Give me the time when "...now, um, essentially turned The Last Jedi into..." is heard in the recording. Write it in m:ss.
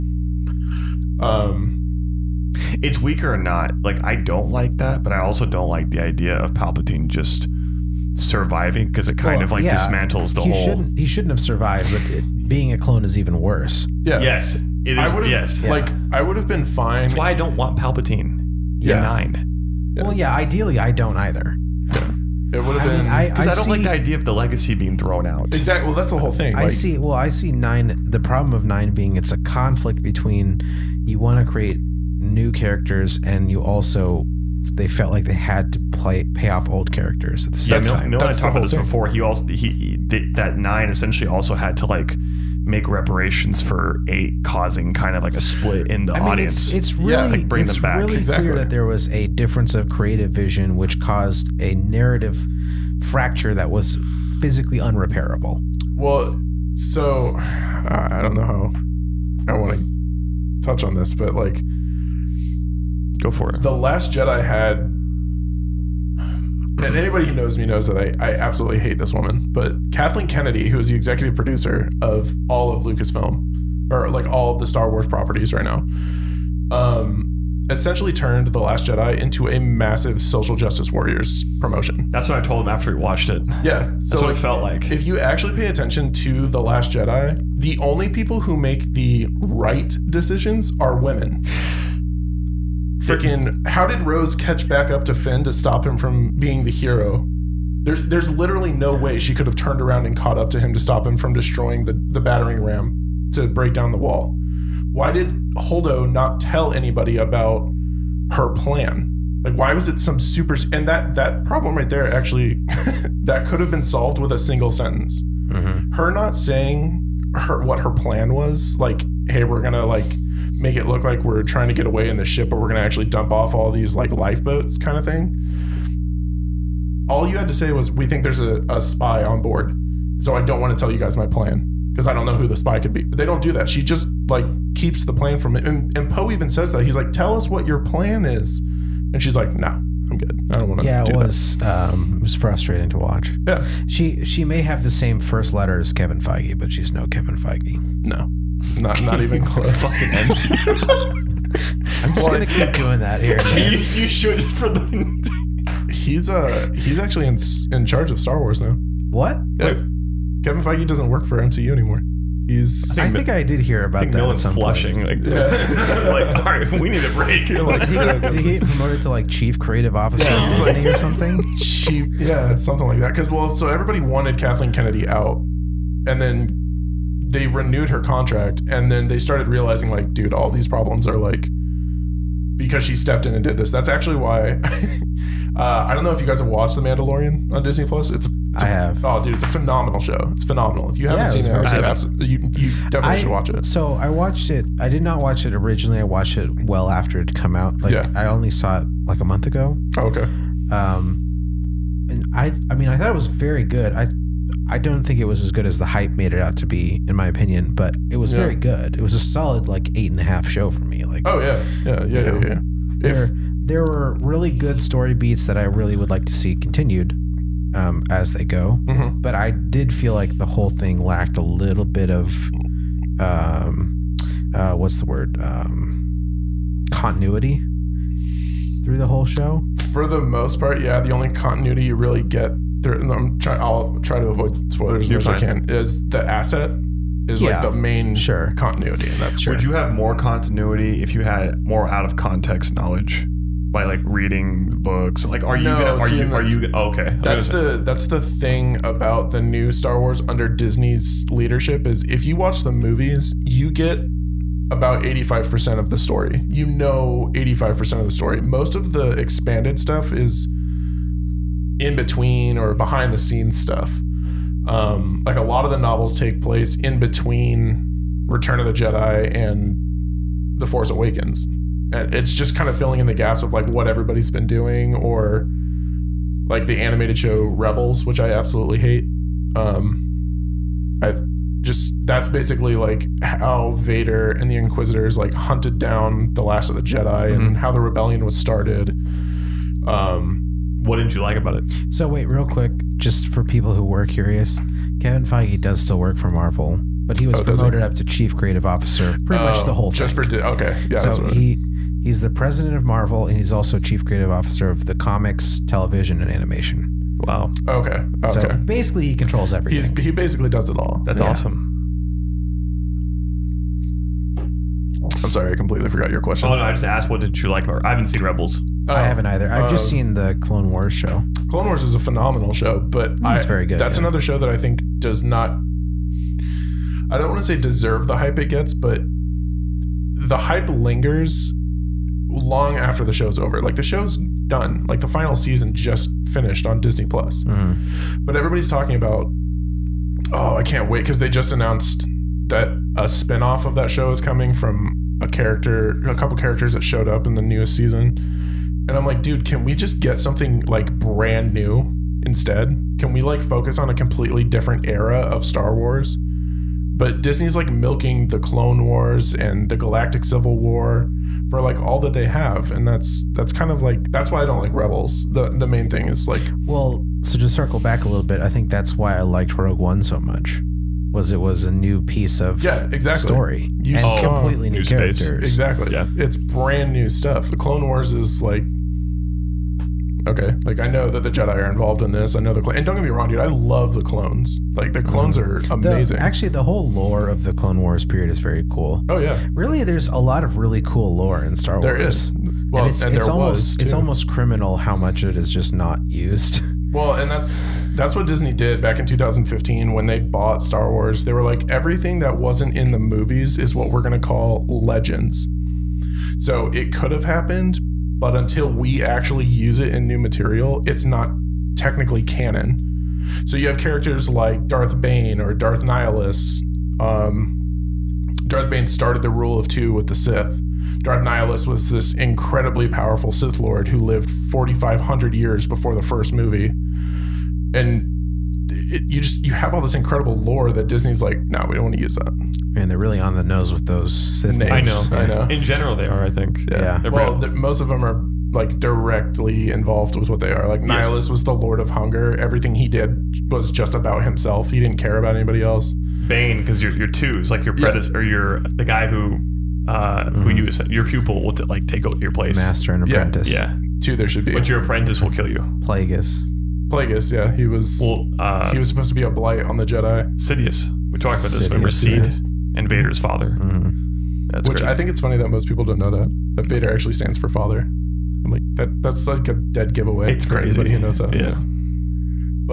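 1:15.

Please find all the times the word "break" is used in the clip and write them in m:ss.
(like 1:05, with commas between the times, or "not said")
1:43, 2:47.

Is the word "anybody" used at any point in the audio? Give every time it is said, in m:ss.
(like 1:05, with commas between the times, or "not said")
1:06, 1:46, 7:25.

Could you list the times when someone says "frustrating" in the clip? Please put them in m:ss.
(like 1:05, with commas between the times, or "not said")
2:22.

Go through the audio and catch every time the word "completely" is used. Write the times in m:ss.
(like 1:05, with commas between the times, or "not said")
5:15, 5:53, 6:14.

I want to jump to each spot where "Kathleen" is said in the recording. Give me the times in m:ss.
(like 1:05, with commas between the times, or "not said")
1:09, 2:54.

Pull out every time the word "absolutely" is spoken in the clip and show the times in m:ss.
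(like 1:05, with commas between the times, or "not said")
1:08, 3:11, 4:38.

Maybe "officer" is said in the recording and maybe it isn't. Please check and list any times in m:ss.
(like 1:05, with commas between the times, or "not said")
2:49, 4:58, 5:04.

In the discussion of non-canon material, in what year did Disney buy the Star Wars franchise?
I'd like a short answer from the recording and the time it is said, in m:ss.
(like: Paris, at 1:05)
2015, at 6:39.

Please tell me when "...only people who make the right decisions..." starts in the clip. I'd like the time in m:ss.
1:27.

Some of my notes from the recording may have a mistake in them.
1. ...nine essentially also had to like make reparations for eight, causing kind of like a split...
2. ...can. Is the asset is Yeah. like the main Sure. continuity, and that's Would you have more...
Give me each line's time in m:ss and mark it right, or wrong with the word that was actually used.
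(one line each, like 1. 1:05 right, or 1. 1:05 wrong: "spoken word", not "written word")
1. 0:40 right
2. 3:55 right.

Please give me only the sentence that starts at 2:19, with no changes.
And she's like, no, I'm good.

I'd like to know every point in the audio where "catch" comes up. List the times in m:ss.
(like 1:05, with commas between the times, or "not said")
1:34.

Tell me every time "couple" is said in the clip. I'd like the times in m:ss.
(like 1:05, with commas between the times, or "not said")
5:46.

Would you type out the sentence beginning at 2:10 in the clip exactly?
So I don't want to tell you guys my plan because I don't know who the spy could be.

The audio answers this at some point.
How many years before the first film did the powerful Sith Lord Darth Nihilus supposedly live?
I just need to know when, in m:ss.
7:04.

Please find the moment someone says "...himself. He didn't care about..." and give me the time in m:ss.
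7:24.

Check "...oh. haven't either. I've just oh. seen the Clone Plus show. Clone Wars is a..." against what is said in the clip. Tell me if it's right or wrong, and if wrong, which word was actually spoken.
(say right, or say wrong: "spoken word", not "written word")
wrong: "Wars", not "Plus".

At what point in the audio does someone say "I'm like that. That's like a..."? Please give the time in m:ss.
7:48.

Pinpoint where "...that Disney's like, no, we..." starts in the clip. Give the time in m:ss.
7:10.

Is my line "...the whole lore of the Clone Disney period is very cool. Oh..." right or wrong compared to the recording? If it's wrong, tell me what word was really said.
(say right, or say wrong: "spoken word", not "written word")
wrong: "Wars", not "Disney".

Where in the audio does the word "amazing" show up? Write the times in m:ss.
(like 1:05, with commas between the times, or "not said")
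6:25.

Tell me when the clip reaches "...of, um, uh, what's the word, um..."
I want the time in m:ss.
3:42.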